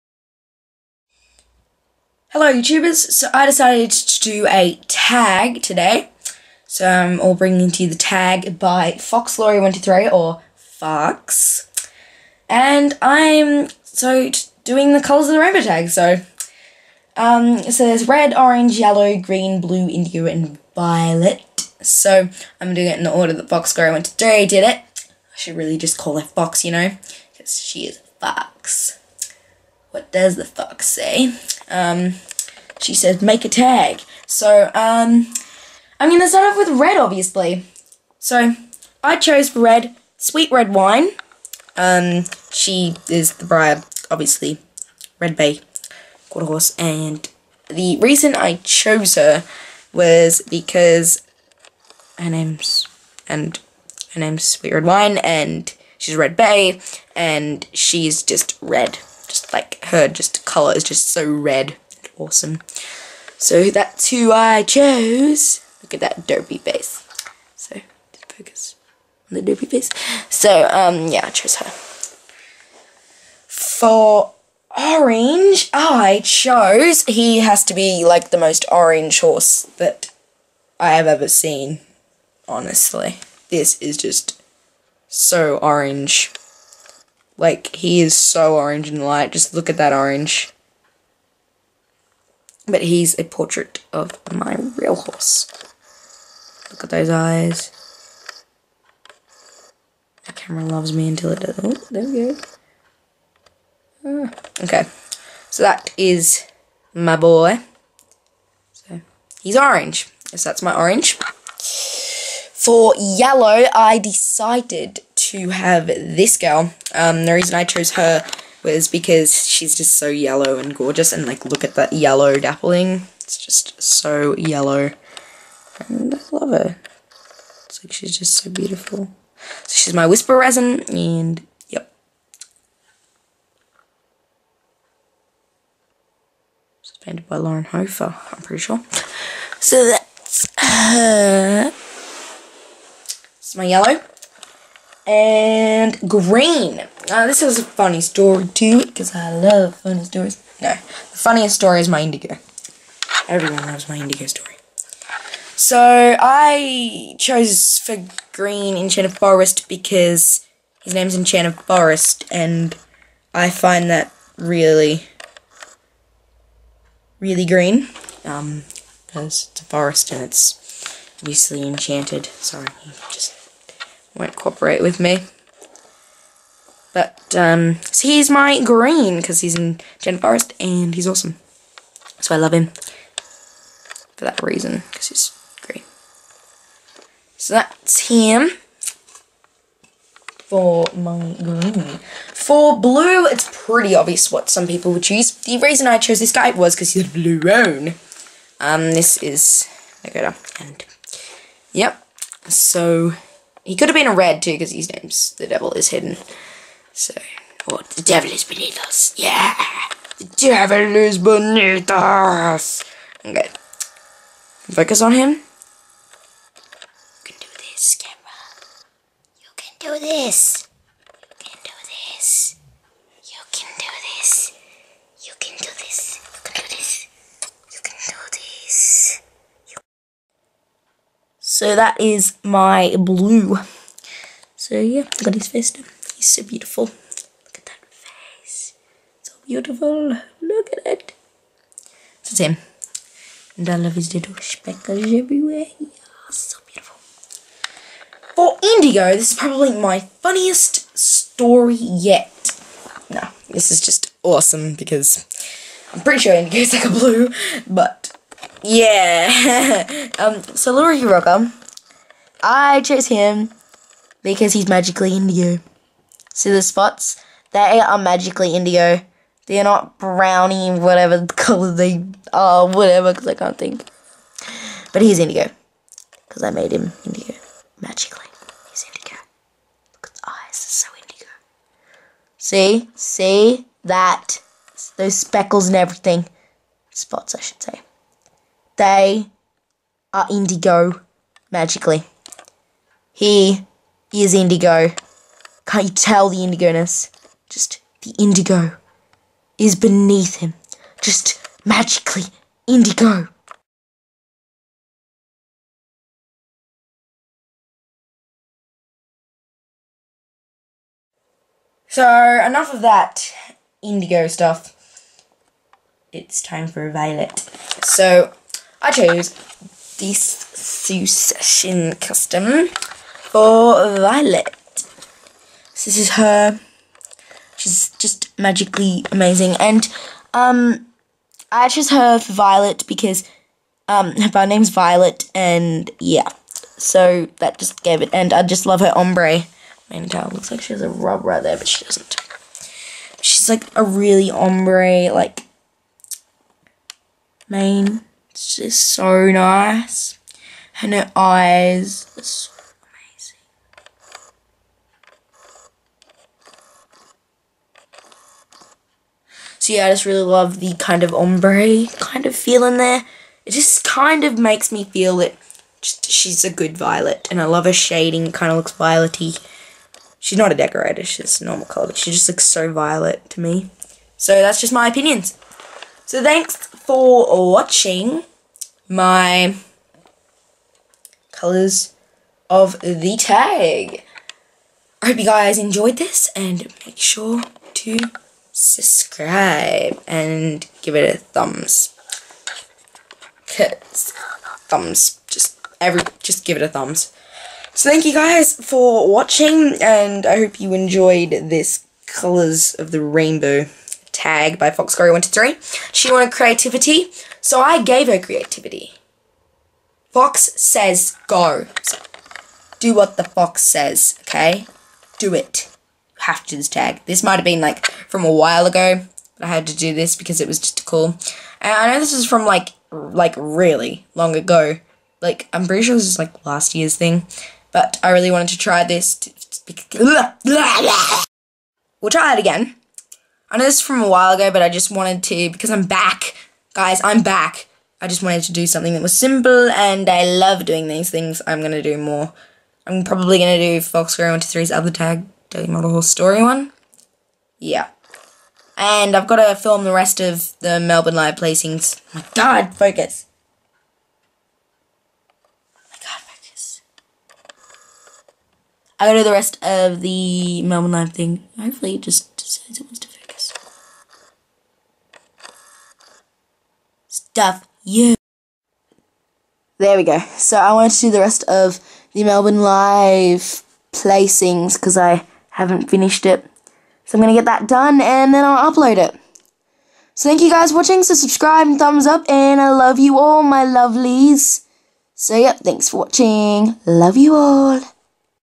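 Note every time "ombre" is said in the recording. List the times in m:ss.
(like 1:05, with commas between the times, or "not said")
5:38, 5:44, 6:01.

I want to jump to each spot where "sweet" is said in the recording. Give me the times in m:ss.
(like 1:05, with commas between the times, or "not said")
0:40, 0:54.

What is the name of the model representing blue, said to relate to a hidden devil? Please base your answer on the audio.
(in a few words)
Nagoda.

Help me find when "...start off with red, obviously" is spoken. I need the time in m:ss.
0:36.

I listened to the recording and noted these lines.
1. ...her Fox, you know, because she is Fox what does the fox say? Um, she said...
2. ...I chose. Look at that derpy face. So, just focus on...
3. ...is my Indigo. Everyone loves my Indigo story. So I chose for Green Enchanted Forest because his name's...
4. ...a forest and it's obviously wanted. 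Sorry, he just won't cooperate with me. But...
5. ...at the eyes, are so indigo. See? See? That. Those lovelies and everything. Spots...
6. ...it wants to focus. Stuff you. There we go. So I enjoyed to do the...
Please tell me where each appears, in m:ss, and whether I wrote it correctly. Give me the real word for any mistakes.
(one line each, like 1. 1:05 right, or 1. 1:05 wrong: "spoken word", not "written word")
1. 0:26 right
2. 1:04 right
3. 2:31 right
4. 2:49 wrong: "enchanted", not "wanted"
5. 4:40 wrong: "speckles", not "lovelies"
6. 7:42 wrong: "wanted", not "enjoyed".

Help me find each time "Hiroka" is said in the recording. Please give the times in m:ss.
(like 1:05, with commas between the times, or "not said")
4:20.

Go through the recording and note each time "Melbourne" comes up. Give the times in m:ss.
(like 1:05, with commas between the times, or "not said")
7:30, 7:40, 7:52.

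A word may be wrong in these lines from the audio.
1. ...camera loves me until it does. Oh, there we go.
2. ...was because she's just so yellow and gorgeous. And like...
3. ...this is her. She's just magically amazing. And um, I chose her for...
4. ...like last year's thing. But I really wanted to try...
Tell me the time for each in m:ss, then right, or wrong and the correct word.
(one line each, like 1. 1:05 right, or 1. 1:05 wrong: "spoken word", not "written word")
1. 1:40 right
2. 1:58 right
3. 5:25 right
4. 7:06 right.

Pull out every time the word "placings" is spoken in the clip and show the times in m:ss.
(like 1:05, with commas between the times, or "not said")
7:31, 7:53.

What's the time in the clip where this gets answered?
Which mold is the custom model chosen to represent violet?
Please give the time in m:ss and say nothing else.
5:20.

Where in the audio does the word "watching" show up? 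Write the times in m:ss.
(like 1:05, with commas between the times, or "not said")
6:17, 6:39, 8:00, 8:05.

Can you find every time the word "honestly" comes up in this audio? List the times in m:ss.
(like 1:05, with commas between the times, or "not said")
1:22.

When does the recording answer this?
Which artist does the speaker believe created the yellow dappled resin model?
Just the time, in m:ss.
2:17.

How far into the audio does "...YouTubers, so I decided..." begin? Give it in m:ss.
0:02.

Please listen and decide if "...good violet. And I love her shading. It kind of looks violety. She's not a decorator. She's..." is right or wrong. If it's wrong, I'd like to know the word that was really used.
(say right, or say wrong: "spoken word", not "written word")
right.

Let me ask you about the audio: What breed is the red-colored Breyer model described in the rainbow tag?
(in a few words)
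Quarter Horse.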